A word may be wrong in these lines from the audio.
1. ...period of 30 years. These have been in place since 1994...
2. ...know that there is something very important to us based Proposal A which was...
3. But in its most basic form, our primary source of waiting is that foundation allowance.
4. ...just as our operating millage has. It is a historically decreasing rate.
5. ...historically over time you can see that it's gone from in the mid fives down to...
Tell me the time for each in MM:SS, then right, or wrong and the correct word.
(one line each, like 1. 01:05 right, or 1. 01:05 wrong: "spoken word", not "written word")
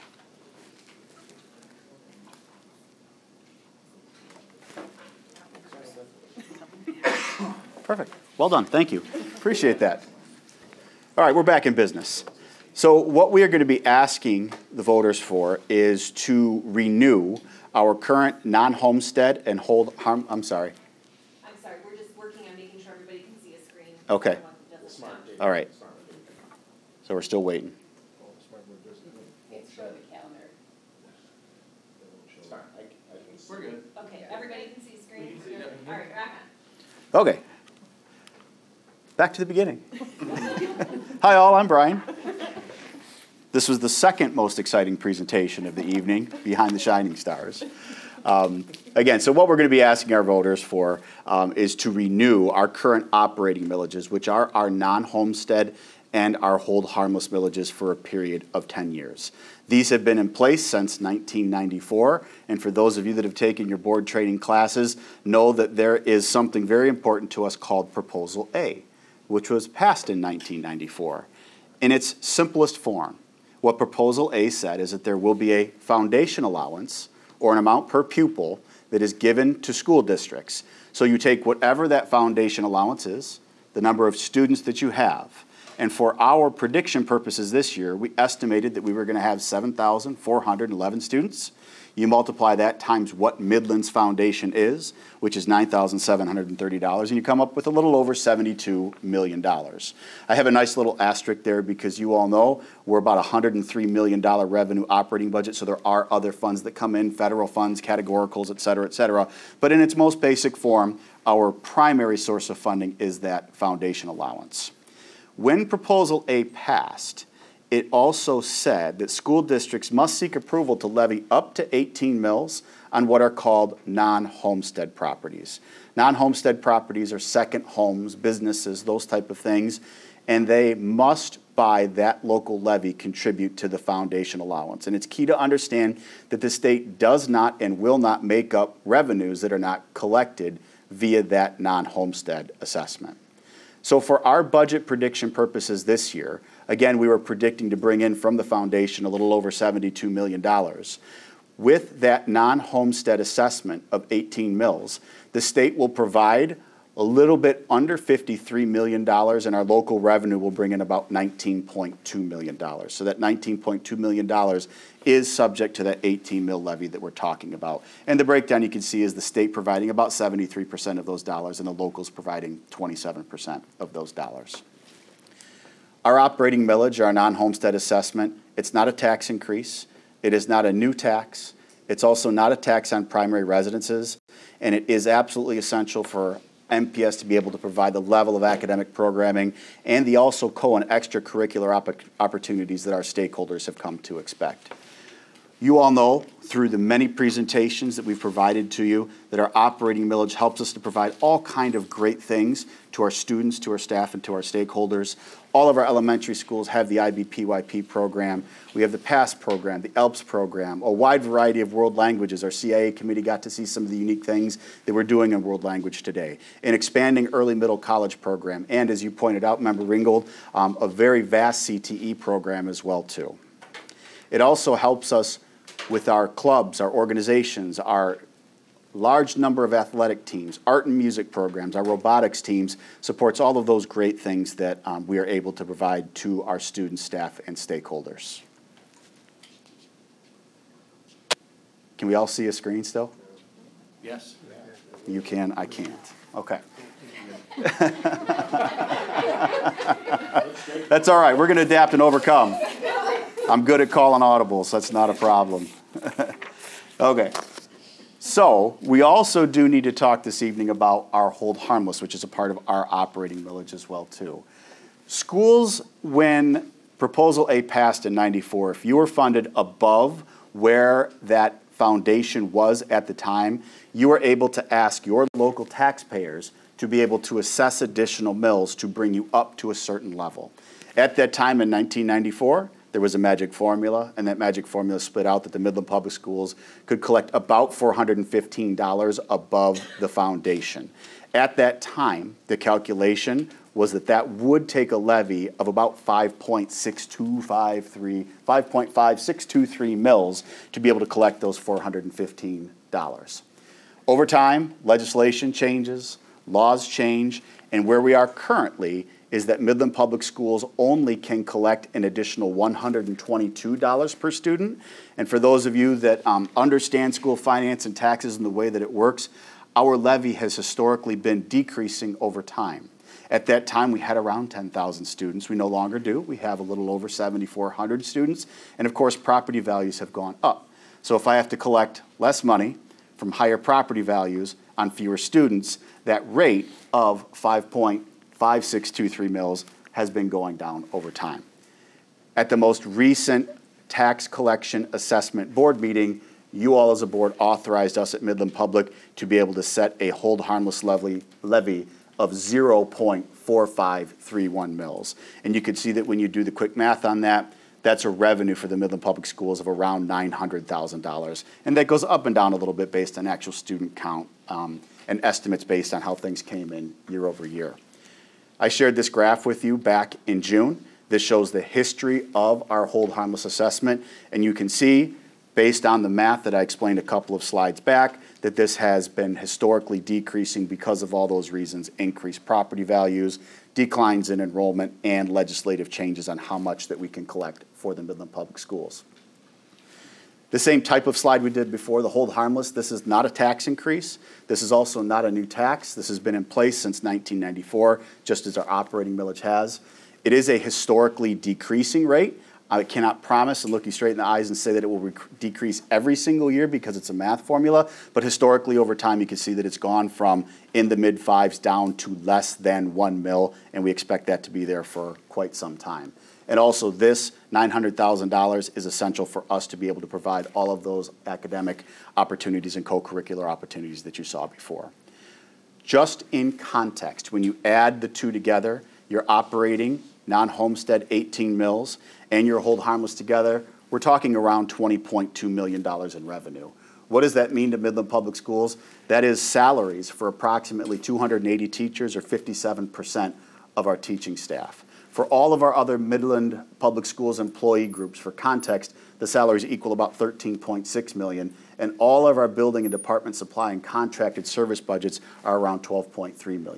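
1. 00:57 wrong: "10", not "30"
2. 01:05 wrong: "called", not "based"
3. 01:49 wrong: "funding", not "waiting"
4. 06:38 right
5. 06:48 right.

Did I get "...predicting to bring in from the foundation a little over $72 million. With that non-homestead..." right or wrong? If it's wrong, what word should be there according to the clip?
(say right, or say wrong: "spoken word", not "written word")
right.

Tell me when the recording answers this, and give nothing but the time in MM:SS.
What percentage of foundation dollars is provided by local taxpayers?
02:52.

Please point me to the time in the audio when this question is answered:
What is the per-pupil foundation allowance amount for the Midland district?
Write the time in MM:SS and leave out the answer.
01:35.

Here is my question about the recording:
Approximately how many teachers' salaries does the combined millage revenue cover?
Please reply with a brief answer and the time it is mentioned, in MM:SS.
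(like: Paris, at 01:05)
280, at 07:20.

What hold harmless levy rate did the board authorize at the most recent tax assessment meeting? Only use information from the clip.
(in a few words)
0.4531 mills.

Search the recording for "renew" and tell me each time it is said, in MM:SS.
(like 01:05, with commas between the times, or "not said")
00:16, 00:51.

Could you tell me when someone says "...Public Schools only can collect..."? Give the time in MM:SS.
05:09.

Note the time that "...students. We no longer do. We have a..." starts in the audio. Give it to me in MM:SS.
05:25.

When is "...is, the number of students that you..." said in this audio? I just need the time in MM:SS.
01:23.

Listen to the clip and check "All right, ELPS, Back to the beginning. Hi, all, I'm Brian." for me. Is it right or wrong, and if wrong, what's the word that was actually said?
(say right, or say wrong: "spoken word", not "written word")
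wrong: "Okay", not "ELPS".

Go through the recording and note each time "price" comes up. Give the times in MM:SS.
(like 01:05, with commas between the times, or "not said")
not said.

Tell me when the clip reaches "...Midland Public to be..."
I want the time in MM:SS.
05:48.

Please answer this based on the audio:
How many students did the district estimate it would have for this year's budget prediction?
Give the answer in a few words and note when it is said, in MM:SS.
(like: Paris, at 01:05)
7,411, at 01:29.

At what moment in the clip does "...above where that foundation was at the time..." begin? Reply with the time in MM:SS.
04:29.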